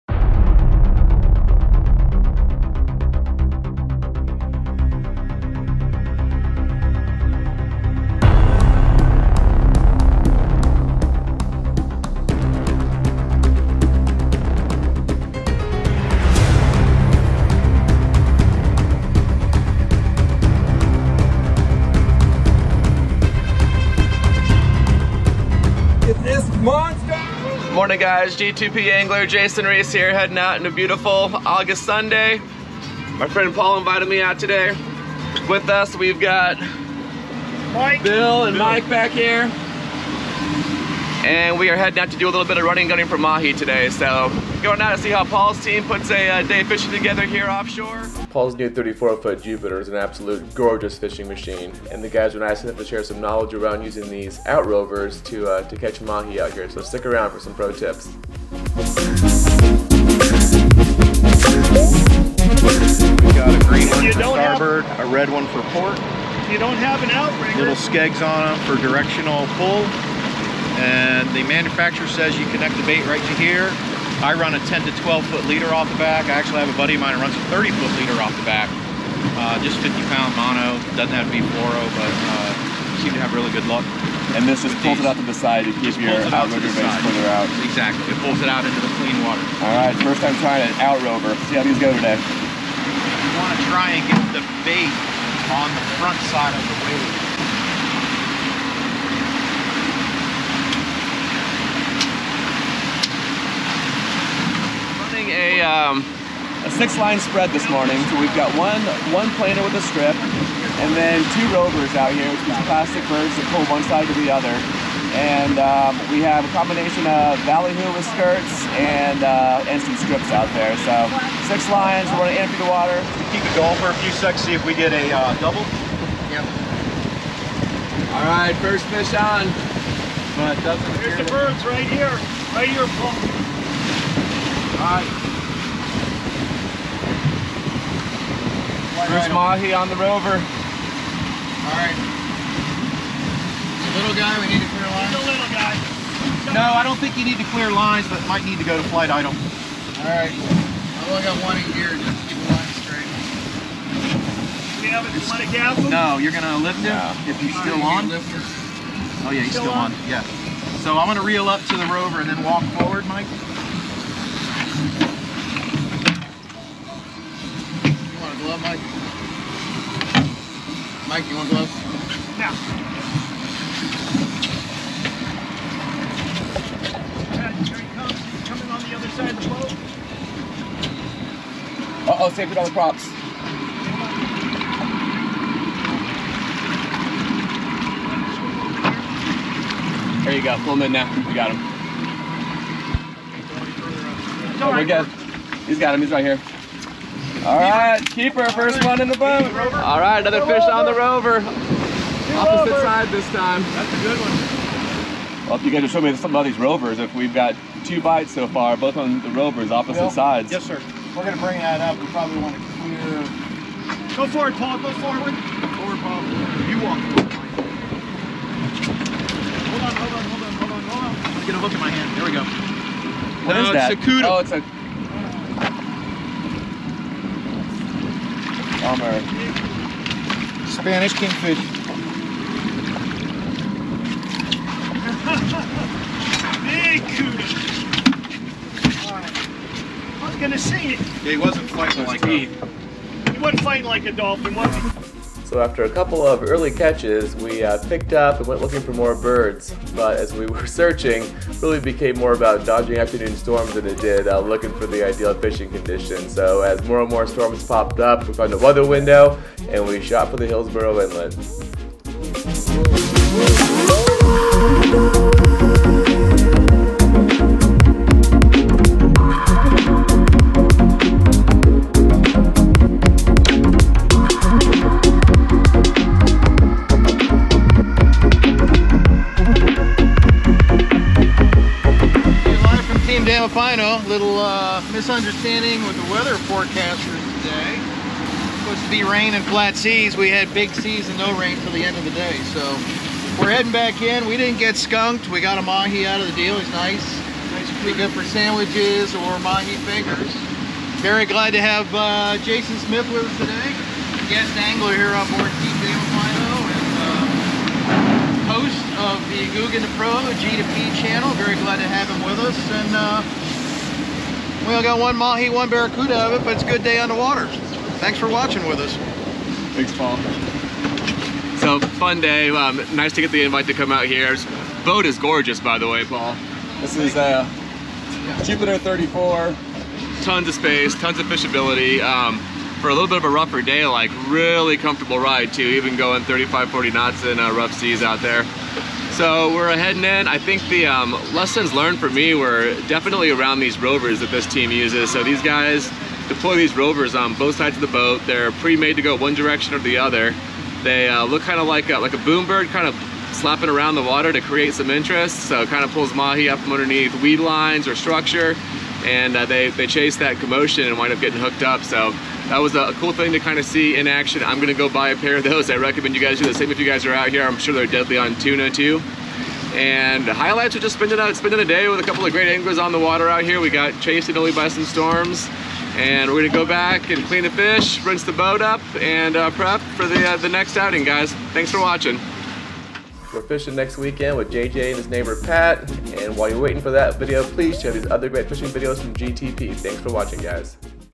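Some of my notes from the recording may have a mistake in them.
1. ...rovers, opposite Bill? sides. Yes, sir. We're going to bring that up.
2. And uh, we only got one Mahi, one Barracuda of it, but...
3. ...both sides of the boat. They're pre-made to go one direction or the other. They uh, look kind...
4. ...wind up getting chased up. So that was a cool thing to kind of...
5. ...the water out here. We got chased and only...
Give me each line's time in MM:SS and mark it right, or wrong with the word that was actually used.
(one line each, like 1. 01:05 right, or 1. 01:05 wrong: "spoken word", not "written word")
1. 03:29 right
2. 05:12 right
3. 05:47 right
4. 06:00 wrong: "hooked", not "chased"
5. 06:12 right.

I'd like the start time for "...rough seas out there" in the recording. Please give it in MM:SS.
05:37.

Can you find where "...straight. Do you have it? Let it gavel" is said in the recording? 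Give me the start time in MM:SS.
02:32.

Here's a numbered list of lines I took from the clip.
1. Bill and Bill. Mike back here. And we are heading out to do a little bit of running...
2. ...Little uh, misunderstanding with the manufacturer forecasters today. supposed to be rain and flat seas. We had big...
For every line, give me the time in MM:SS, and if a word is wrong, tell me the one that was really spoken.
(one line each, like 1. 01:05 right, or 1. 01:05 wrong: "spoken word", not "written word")
1. 00:38 right
2. 04:44 wrong: "weather", not "manufacturer".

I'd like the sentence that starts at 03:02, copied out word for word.
Uh-oh, saved it on the props.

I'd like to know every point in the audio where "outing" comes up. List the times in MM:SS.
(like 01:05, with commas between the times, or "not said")
06:20.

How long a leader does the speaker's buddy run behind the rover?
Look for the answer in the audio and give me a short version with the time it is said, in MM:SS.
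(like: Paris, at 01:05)
30 foot, at 01:17.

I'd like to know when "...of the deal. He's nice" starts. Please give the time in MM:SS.
04:56.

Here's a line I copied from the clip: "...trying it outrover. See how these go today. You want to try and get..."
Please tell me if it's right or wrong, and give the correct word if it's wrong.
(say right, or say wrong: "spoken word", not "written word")
right.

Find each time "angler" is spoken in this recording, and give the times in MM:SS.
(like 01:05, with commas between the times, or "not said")
00:28, 05:04, 06:12.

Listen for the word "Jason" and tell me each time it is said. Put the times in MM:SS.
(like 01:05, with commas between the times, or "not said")
00:29, 05:02.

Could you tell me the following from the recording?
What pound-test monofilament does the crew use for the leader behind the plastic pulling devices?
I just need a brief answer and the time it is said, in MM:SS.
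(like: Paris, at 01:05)
50 pound, at 01:19.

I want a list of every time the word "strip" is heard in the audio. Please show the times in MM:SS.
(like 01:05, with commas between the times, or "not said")
01:49, 01:59.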